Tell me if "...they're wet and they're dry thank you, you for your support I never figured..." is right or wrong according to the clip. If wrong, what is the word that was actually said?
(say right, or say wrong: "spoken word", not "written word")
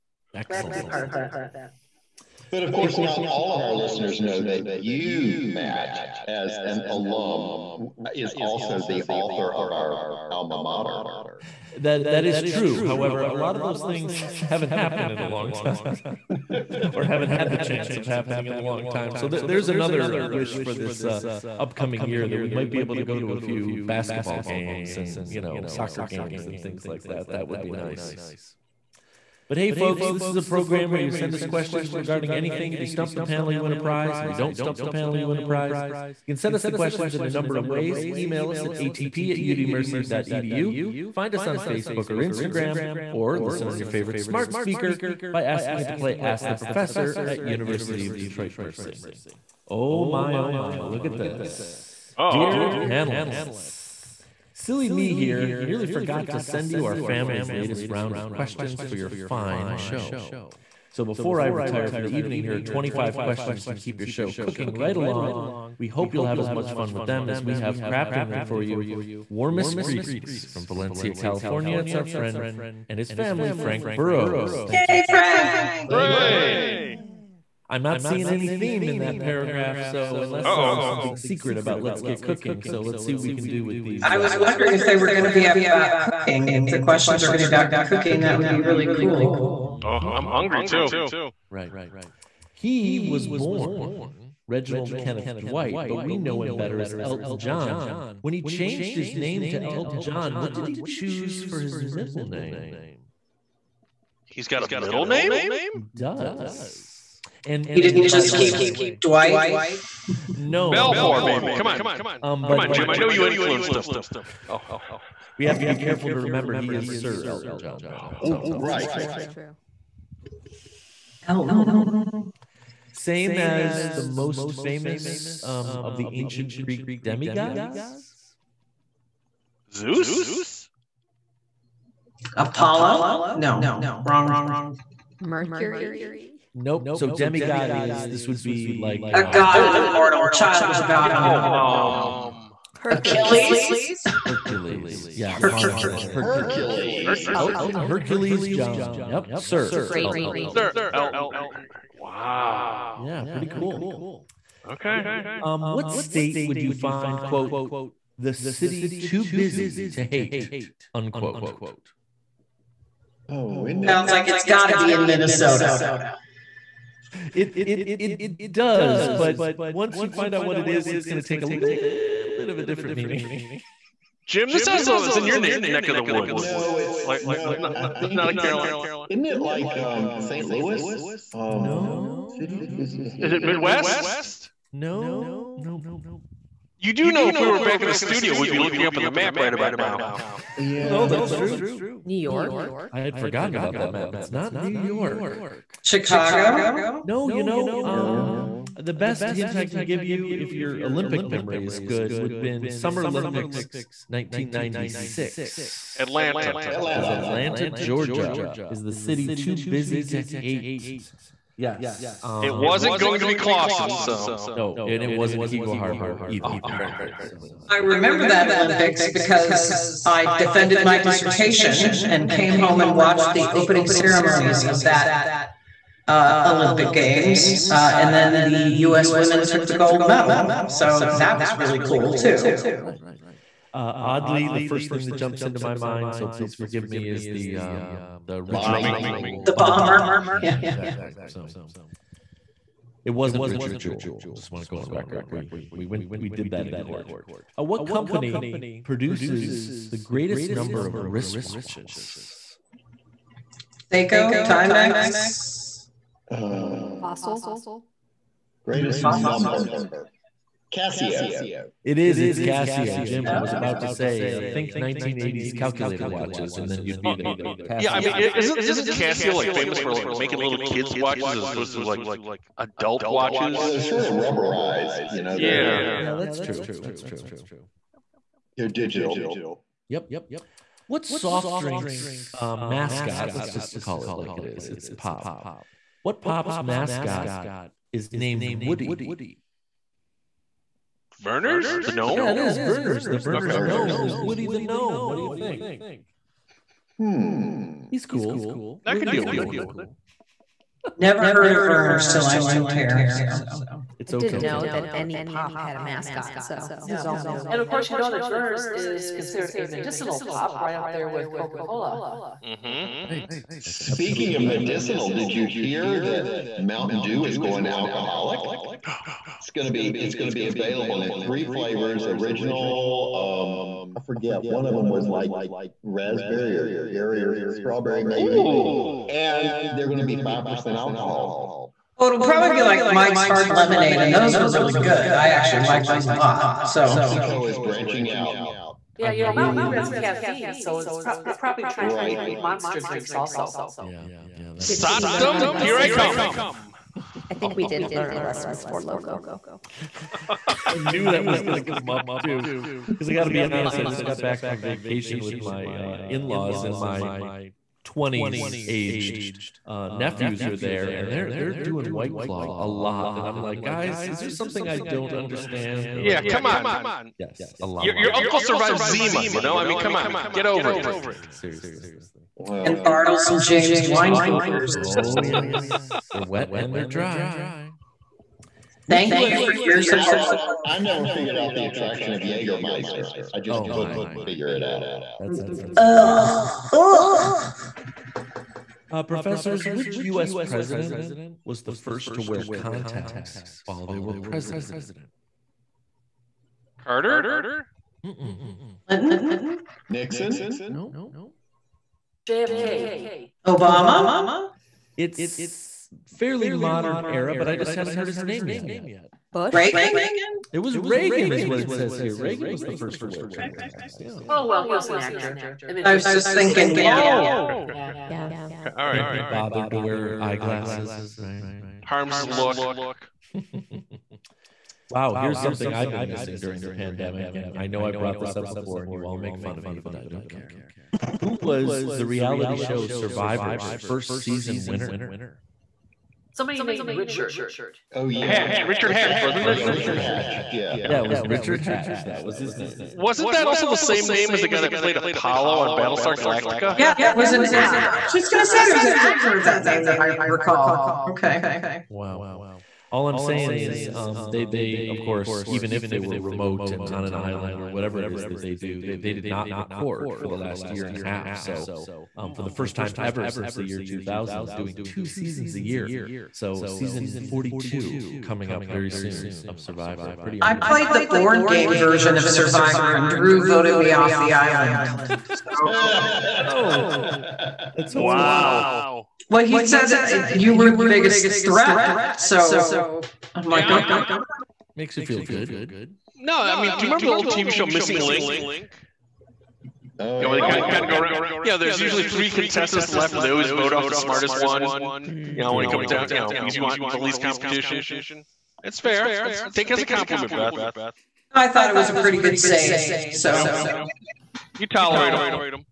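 right.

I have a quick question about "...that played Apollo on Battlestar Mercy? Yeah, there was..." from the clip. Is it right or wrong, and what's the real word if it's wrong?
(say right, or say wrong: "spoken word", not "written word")
wrong: "Galactica", not "Mercy".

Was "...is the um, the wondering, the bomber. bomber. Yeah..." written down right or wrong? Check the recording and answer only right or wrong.
wrong.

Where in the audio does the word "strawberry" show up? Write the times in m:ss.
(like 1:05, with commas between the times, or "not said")
5:27.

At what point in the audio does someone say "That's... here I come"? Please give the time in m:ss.
5:44.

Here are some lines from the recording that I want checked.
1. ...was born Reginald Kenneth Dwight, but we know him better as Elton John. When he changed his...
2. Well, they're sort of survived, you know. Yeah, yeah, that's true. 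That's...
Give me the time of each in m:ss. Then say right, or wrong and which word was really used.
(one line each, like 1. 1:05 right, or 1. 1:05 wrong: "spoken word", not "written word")
1. 1:33 right
2. 4:33 wrong: "rubberized", not "survived".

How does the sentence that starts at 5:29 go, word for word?
and they're going to be five percent alcohol.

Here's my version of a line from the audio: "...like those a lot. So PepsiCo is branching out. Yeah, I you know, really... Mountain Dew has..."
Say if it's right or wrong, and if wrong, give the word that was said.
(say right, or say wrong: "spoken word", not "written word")
right.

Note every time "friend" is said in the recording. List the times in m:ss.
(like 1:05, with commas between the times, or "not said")
1:12.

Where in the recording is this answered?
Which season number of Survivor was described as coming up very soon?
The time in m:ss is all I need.
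7:47.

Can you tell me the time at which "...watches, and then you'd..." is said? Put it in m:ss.
4:26.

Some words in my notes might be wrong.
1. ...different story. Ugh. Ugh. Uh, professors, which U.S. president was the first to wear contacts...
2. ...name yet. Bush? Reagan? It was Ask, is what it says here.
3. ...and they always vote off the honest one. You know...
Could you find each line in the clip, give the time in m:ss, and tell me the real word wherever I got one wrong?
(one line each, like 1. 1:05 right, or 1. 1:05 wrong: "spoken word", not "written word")
1. 6:25 right
2. 6:48 wrong: "Reagan", not "Ask"
3. 8:13 wrong: "smartest", not "honest".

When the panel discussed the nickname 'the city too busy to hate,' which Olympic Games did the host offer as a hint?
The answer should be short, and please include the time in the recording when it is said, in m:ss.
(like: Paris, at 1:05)
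Summer Olympics 1996, at 3:22.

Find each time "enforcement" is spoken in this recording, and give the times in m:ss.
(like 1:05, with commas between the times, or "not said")
not said.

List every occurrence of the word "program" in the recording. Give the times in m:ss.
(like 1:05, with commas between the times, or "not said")
0:30.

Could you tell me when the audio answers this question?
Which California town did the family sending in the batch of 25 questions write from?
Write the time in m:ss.
1:10.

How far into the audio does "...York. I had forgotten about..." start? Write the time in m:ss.
3:12.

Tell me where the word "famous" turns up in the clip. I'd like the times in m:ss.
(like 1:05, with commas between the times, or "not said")
2:04, 4:29.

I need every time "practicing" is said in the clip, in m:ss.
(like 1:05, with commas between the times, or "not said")
not said.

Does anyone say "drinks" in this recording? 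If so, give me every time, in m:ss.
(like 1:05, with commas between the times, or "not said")
4:41, 5:42.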